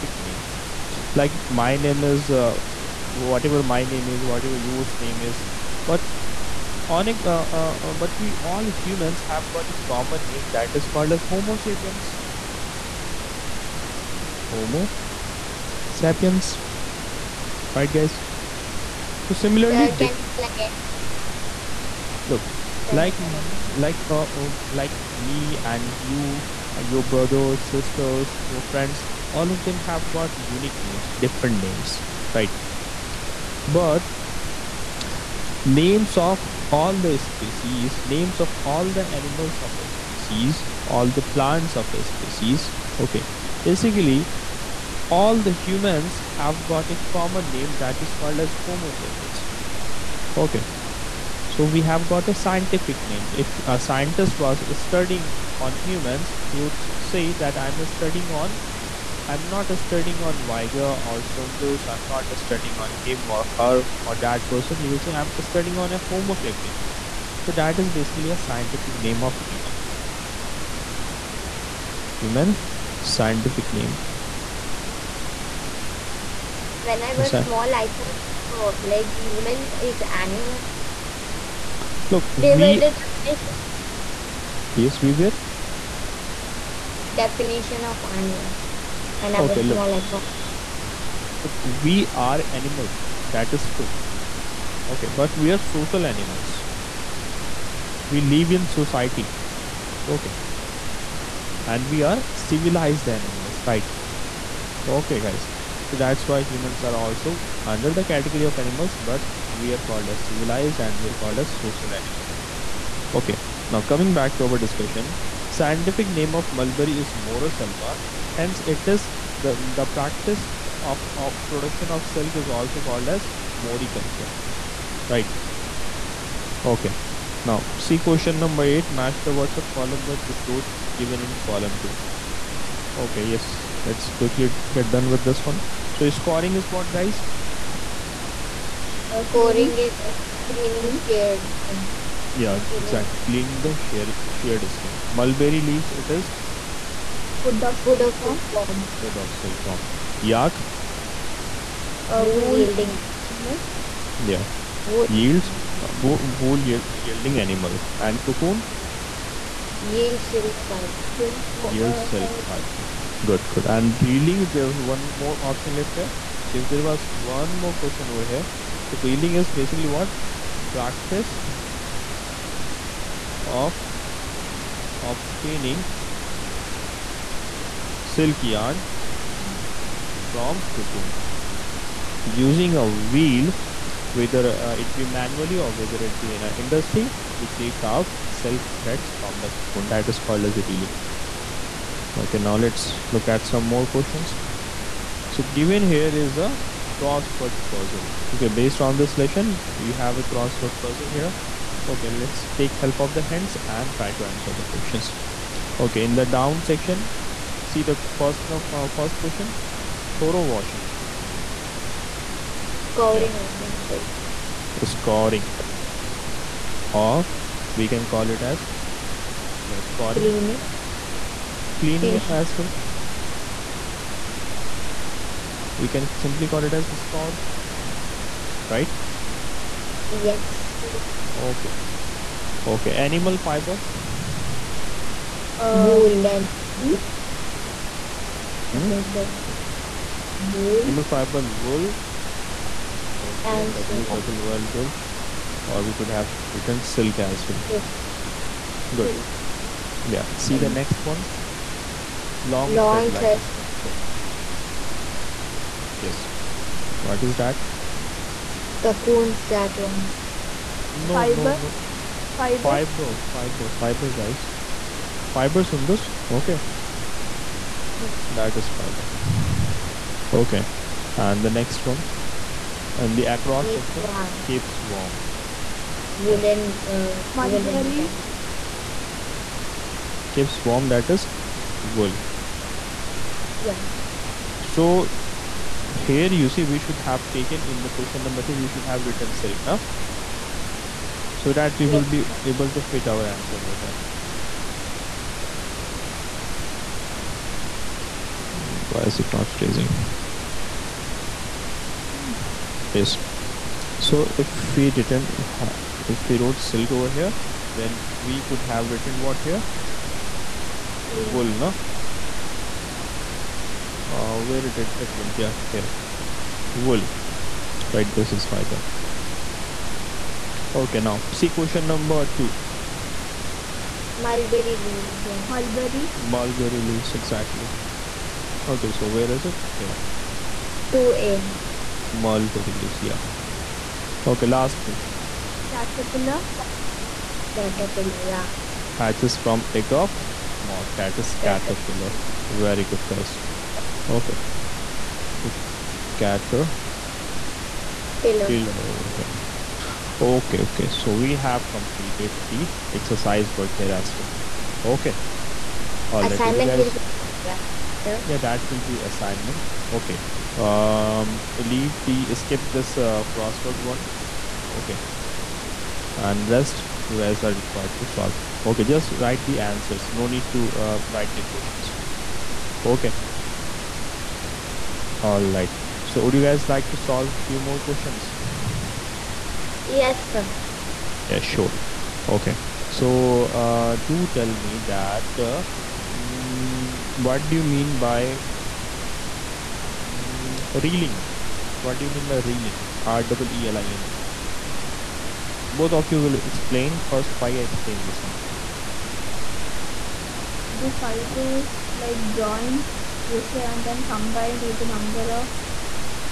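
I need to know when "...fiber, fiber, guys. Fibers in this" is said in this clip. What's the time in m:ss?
4:23.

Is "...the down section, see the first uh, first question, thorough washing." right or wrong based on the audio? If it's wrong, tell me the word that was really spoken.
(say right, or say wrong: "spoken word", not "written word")
right.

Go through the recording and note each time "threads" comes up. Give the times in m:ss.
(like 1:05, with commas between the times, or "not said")
3:08, 4:13.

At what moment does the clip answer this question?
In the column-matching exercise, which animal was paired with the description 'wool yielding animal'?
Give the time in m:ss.
2:30.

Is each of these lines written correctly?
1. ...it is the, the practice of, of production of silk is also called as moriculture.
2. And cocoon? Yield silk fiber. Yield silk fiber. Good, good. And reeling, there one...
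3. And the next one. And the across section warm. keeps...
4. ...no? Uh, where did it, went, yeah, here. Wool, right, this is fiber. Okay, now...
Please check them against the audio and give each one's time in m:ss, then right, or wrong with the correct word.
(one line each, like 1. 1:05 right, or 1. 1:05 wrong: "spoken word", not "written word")
1. 1:58 right
2. 2:38 right
3. 4:31 right
4. 5:11 right.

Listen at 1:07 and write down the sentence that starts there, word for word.
So that is basically a scientific name of human.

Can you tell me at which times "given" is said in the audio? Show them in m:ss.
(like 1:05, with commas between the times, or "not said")
2:10, 3:15.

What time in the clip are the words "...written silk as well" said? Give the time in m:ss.
4:06.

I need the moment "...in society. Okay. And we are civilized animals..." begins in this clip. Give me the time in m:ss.
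1:38.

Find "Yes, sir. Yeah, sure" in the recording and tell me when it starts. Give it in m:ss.
6:19.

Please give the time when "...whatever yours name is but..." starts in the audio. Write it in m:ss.
0:04.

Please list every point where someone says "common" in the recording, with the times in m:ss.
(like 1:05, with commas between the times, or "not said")
0:09, 0:47.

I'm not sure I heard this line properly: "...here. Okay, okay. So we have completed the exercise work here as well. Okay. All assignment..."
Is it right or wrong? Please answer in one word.
right.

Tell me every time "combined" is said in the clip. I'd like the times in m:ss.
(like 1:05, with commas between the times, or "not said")
6:44.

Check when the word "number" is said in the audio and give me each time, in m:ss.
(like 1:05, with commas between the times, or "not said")
2:08, 4:48, 5:21, 6:44.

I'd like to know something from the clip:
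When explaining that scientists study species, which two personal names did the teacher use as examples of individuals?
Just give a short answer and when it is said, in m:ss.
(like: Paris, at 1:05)
Weiger or Sundus, at 1:00.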